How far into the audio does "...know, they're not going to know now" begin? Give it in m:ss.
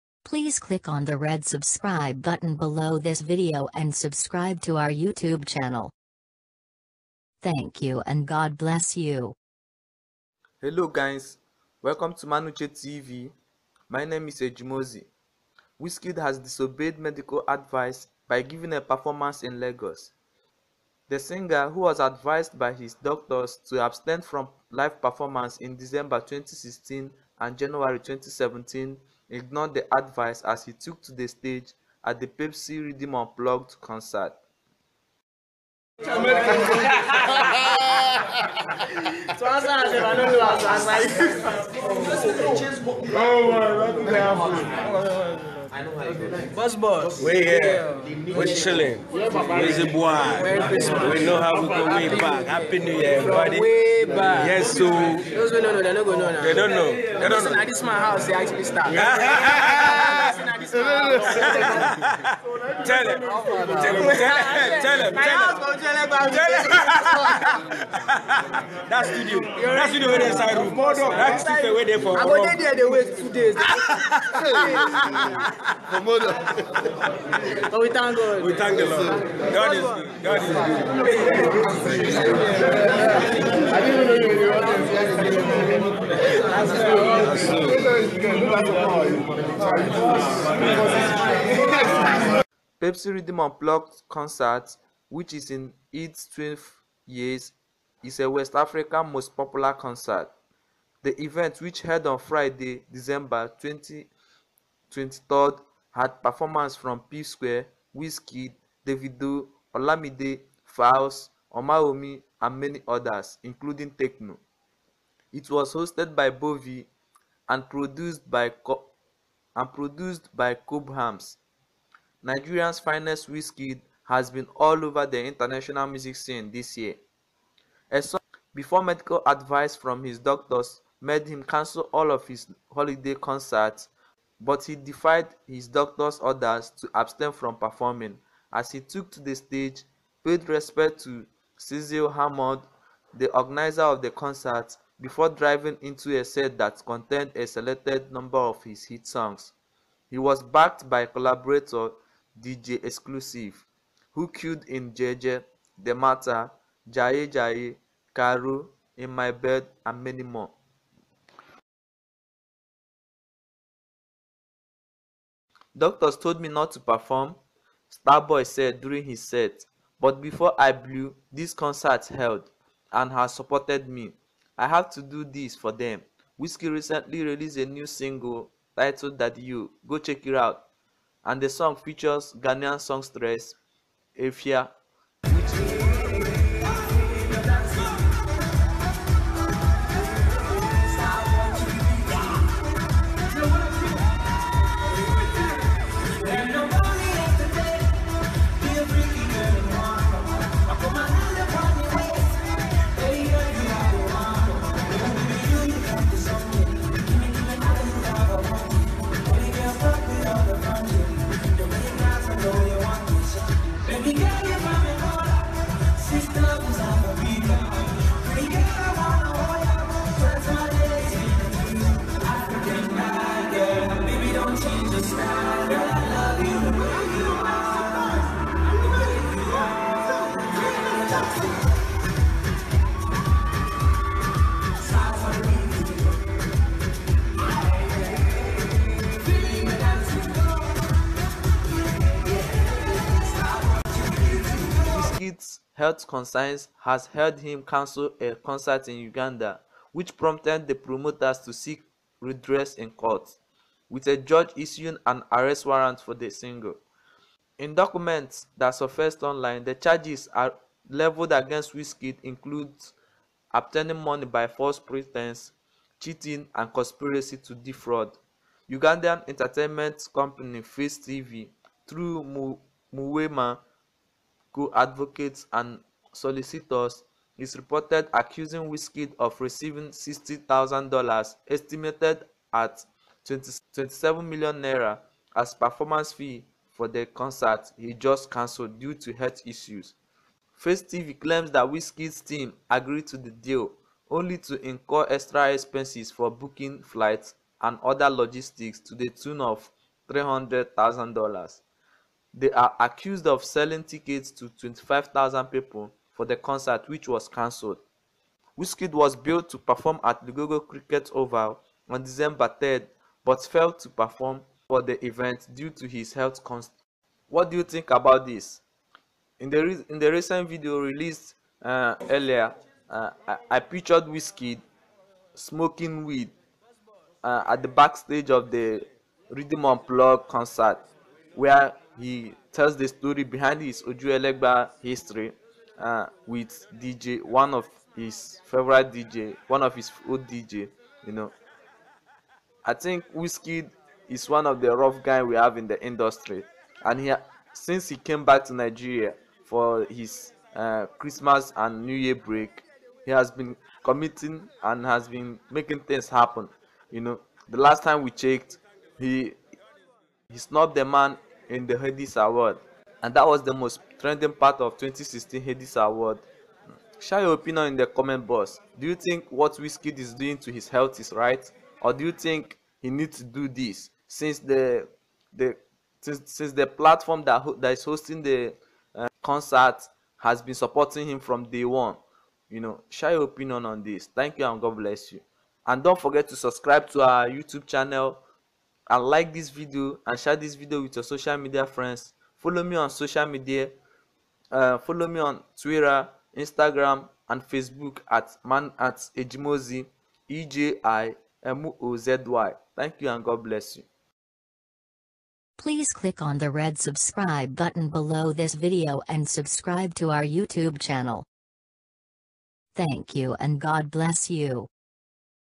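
0:55.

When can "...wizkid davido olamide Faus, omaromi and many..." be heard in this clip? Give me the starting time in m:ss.
1:47.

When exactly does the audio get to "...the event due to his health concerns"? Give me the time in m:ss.
5:14.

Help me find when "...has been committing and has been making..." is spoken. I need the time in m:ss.
5:53.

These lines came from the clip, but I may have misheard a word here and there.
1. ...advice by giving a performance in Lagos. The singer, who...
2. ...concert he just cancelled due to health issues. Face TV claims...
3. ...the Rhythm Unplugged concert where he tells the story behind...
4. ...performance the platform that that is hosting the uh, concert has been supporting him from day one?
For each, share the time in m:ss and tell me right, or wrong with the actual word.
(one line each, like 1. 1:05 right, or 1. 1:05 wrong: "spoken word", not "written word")
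1. 0:17 right
2. 4:47 right
3. 5:28 right
4. 6:16 wrong: "since", not "performance".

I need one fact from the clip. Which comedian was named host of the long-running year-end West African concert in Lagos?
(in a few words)
Bovy.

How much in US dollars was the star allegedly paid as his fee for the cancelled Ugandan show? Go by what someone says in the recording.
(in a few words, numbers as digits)
$60,000.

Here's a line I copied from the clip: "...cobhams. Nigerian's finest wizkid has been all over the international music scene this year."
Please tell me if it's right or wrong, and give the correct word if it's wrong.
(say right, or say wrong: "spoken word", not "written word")
right.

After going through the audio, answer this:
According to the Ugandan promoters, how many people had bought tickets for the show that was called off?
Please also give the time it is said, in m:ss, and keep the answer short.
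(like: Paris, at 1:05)
25,000, at 5:04.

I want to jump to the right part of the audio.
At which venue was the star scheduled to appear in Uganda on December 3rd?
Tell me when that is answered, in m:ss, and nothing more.
5:10.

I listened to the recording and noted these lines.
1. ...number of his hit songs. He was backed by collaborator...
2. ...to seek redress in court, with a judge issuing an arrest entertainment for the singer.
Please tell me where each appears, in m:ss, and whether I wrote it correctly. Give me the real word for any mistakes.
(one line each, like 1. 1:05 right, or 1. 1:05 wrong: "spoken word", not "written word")
1. 2:28 right
2. 4:11 wrong: "warrant", not "entertainment".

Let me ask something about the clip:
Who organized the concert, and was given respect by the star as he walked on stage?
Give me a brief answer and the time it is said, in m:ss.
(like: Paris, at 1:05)
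Cecil Hammond, at 2:21.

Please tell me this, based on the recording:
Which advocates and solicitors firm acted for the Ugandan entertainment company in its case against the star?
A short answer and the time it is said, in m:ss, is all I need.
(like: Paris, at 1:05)
Muwema, at 4:32.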